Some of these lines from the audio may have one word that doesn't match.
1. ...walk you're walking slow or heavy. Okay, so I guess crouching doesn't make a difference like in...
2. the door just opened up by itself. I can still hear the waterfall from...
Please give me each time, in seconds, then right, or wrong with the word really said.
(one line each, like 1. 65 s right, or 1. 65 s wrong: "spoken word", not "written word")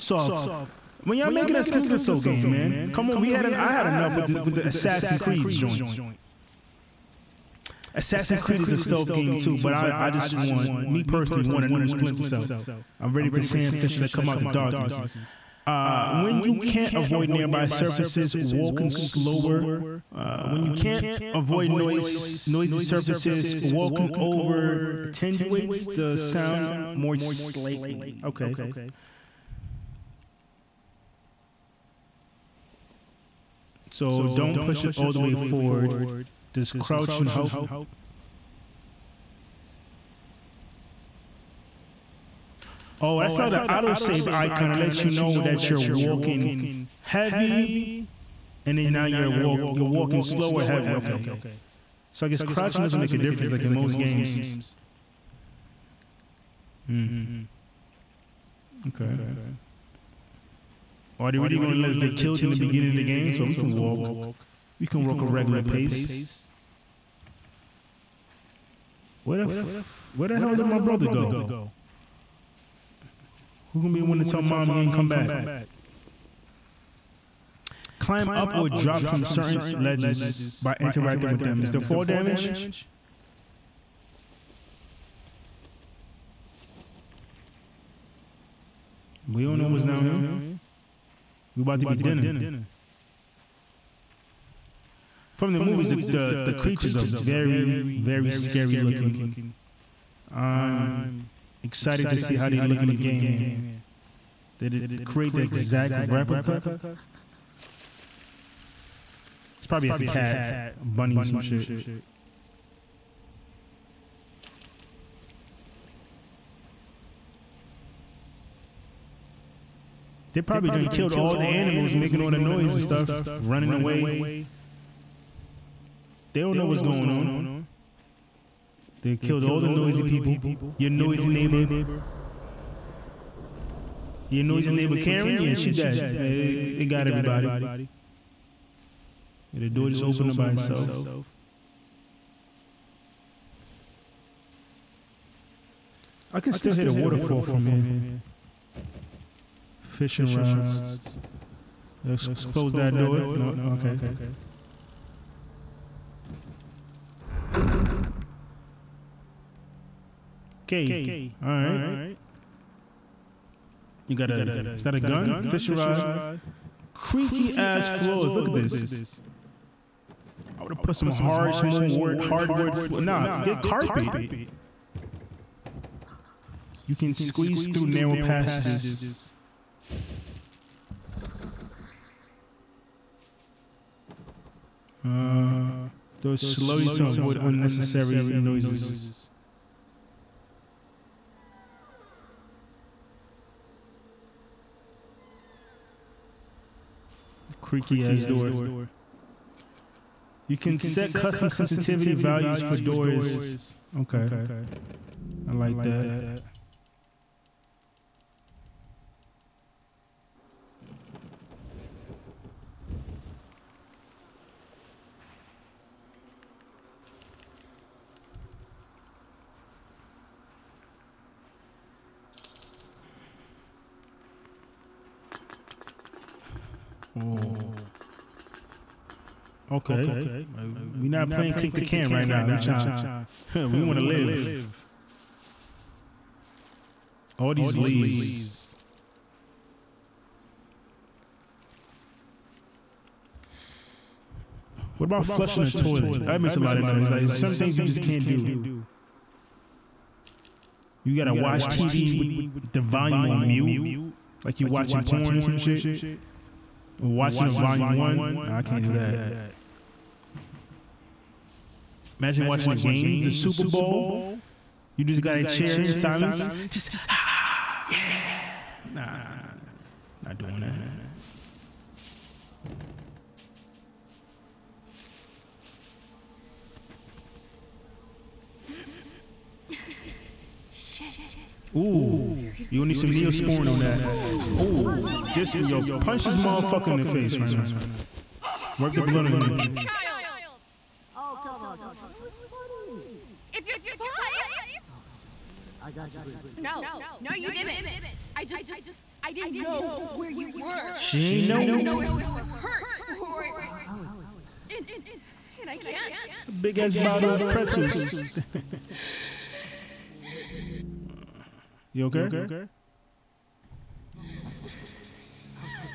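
1. 49 s right
2. 139 s right.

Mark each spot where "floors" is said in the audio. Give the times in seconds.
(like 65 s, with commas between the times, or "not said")
167 s, 172 s.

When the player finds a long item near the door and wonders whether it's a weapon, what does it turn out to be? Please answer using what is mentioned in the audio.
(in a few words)
Fishing rod.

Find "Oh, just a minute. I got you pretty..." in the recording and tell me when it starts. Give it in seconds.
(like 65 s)
294 s.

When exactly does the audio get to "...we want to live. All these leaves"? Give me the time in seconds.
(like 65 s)
233 s.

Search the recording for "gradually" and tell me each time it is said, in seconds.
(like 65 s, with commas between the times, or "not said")
not said.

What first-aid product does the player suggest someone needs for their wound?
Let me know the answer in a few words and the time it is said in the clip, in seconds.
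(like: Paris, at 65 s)
Neosporin, at 283 s.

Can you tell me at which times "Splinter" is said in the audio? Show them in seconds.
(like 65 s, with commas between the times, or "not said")
1 s, 11 s.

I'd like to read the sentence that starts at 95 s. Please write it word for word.
From the movies, the, the, the creatures are very, very scary looking.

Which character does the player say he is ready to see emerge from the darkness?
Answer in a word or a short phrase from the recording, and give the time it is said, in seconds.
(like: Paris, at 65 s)
Sam Fisher, at 13 s.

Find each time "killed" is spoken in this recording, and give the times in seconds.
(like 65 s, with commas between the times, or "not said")
62 s, 120 s, 129 s.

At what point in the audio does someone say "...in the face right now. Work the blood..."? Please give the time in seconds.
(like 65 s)
286 s.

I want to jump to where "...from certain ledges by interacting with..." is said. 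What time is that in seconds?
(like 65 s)
79 s.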